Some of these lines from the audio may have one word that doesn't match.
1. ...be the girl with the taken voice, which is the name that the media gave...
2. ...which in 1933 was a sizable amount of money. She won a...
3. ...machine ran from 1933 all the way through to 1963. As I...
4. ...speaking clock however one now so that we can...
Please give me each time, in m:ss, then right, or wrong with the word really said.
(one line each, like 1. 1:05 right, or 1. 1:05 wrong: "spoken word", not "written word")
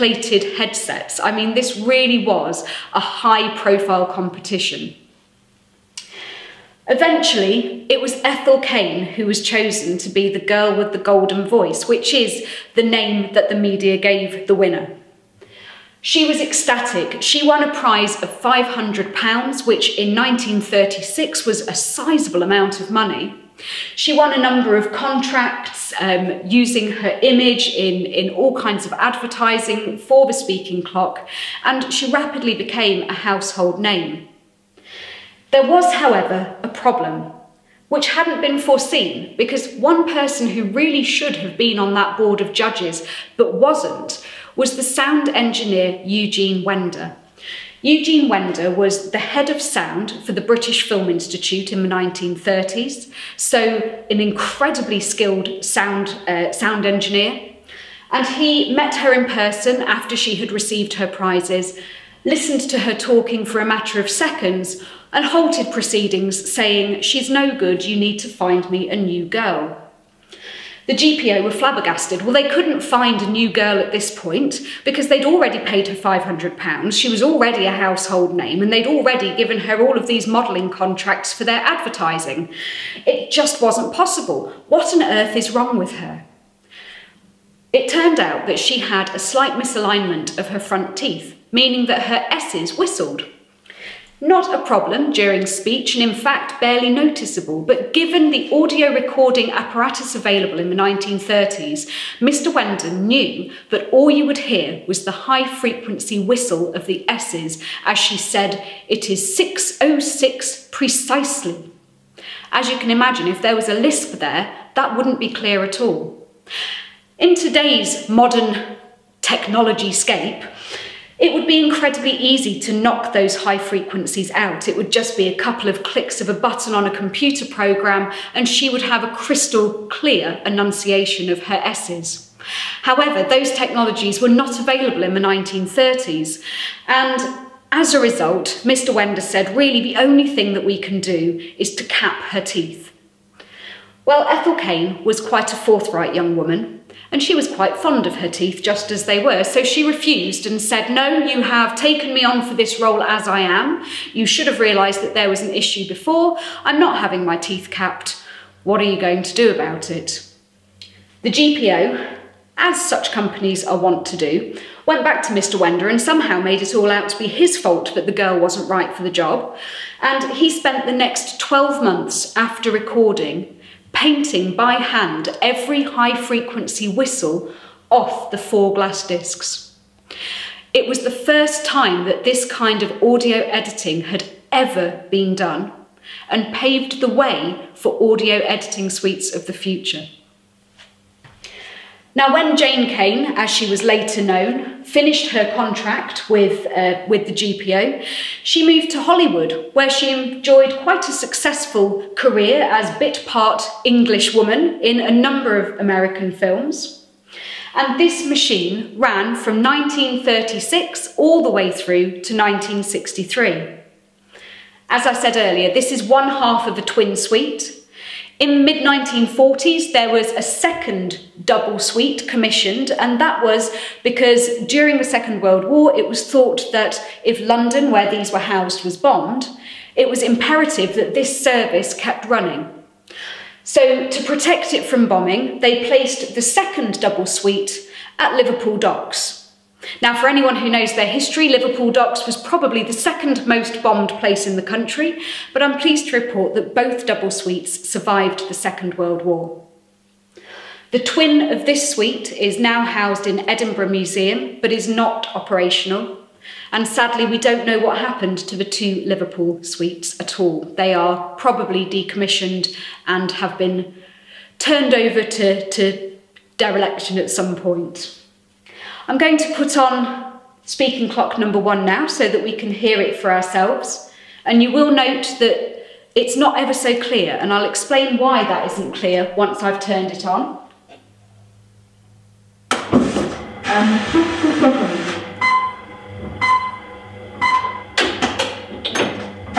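1. 0:10 wrong: "golden", not "taken"
2. 0:19 wrong: "1936", not "1933"
3. 3:28 wrong: "1936", not "1933"
4. 4:30 wrong: "number", not "however".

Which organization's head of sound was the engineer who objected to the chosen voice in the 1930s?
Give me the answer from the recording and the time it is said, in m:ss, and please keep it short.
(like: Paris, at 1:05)
British Film Institute, at 0:50.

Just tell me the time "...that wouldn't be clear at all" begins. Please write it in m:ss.
1:54.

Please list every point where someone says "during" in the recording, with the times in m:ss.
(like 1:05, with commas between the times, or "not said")
1:35, 3:44.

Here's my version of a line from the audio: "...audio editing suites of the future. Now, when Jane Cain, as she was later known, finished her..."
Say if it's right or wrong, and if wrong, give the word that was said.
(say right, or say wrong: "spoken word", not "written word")
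right.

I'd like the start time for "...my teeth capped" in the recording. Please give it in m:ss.
2:37.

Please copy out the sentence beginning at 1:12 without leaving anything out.
Well, they couldn't find a new girl at this point because they'd already paid her £500.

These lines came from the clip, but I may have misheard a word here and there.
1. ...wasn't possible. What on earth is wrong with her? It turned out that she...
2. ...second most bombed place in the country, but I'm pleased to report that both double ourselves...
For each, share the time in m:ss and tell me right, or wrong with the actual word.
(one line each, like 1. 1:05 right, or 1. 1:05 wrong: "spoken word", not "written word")
1. 1:23 right
2. 4:02 wrong: "suites", not "ourselves".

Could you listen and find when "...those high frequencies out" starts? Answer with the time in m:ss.
2:03.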